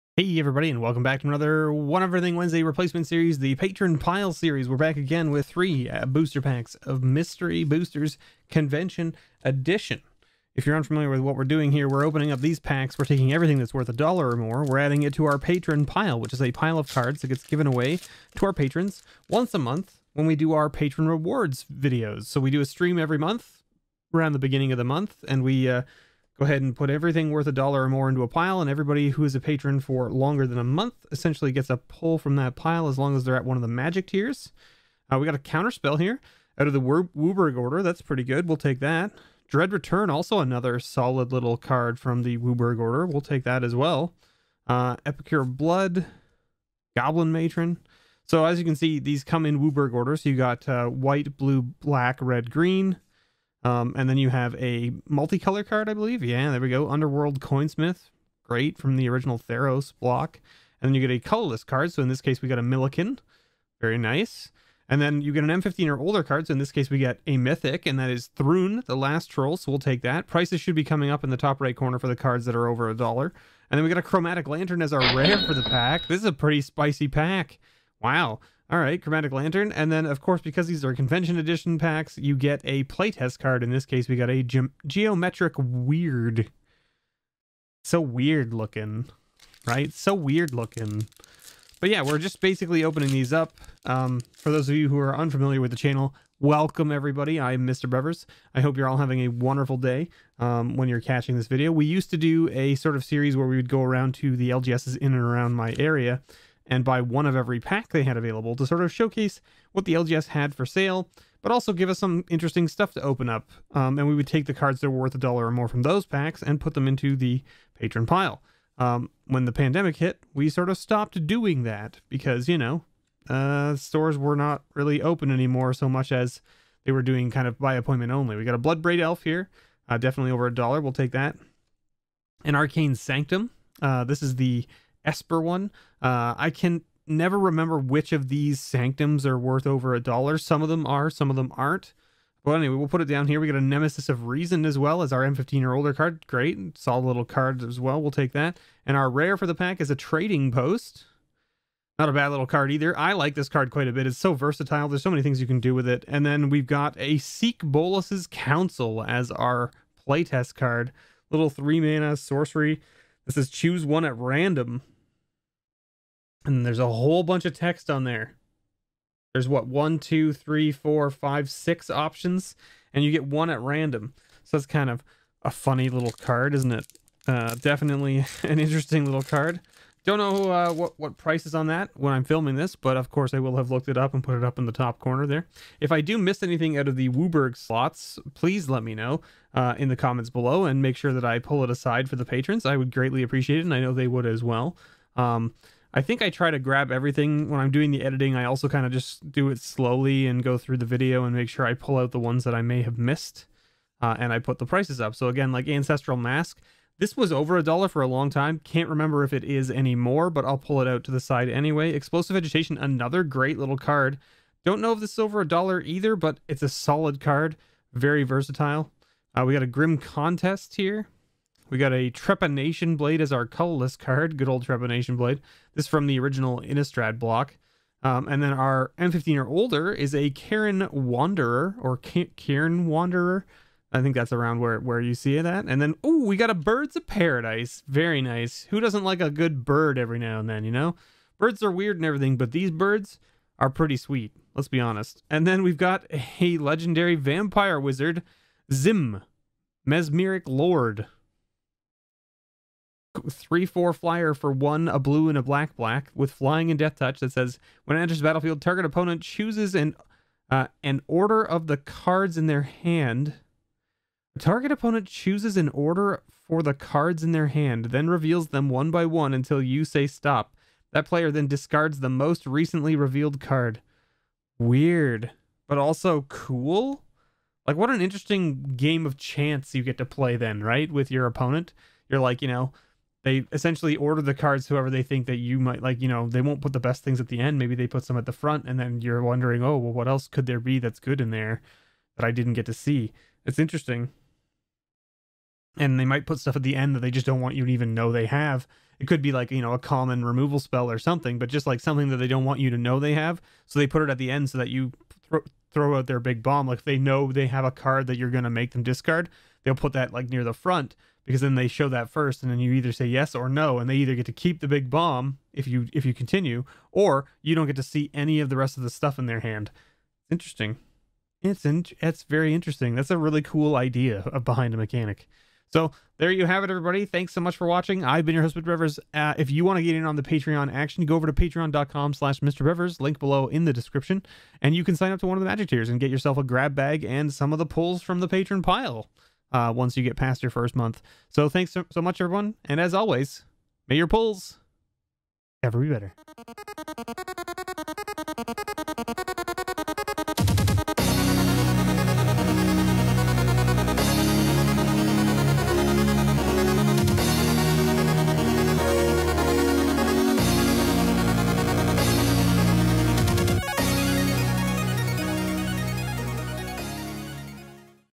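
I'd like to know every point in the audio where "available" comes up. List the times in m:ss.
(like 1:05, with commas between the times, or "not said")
1:48.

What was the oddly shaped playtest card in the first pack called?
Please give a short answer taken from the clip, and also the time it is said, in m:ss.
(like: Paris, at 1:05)
Geometric Weird, at 1:24.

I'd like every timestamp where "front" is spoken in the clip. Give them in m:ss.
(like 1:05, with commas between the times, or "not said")
4:48, 5:10.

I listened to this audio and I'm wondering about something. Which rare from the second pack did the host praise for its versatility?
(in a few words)
Trading Post.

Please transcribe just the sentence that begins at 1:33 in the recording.
Um, for those of you who are unfamiliar with the channel, welcome everybody.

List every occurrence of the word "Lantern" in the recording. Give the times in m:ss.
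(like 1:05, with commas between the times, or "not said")
1:14, 1:19.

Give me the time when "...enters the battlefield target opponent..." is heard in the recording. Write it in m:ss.
4:18.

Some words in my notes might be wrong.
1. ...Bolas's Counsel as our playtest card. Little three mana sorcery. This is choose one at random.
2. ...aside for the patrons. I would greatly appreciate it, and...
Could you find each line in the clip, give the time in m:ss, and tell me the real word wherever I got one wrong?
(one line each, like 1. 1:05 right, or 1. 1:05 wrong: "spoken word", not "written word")
1. 2:37 right
2. 3:11 right.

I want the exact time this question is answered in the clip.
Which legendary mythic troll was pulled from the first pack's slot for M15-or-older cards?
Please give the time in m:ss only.
1:08.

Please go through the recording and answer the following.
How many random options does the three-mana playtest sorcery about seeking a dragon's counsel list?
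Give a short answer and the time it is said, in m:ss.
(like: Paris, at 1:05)
6, at 2:51.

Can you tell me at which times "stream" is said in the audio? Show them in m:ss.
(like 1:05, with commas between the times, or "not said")
0:22.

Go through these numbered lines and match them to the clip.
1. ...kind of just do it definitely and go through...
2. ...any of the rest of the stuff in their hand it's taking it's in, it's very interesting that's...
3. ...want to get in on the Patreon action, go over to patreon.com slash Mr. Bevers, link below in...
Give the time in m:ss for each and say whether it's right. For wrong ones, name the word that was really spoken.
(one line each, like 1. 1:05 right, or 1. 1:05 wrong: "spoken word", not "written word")
1. 3:18 wrong: "slowly", not "definitely"
2. 5:18 wrong: "interesting", not "taking"
3. 5:29 right.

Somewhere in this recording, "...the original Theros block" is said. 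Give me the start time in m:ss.
0:58.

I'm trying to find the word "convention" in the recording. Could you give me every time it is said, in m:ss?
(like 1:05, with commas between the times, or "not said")
0:08, 1:20.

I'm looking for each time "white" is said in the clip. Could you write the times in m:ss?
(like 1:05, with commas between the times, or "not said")
0:50.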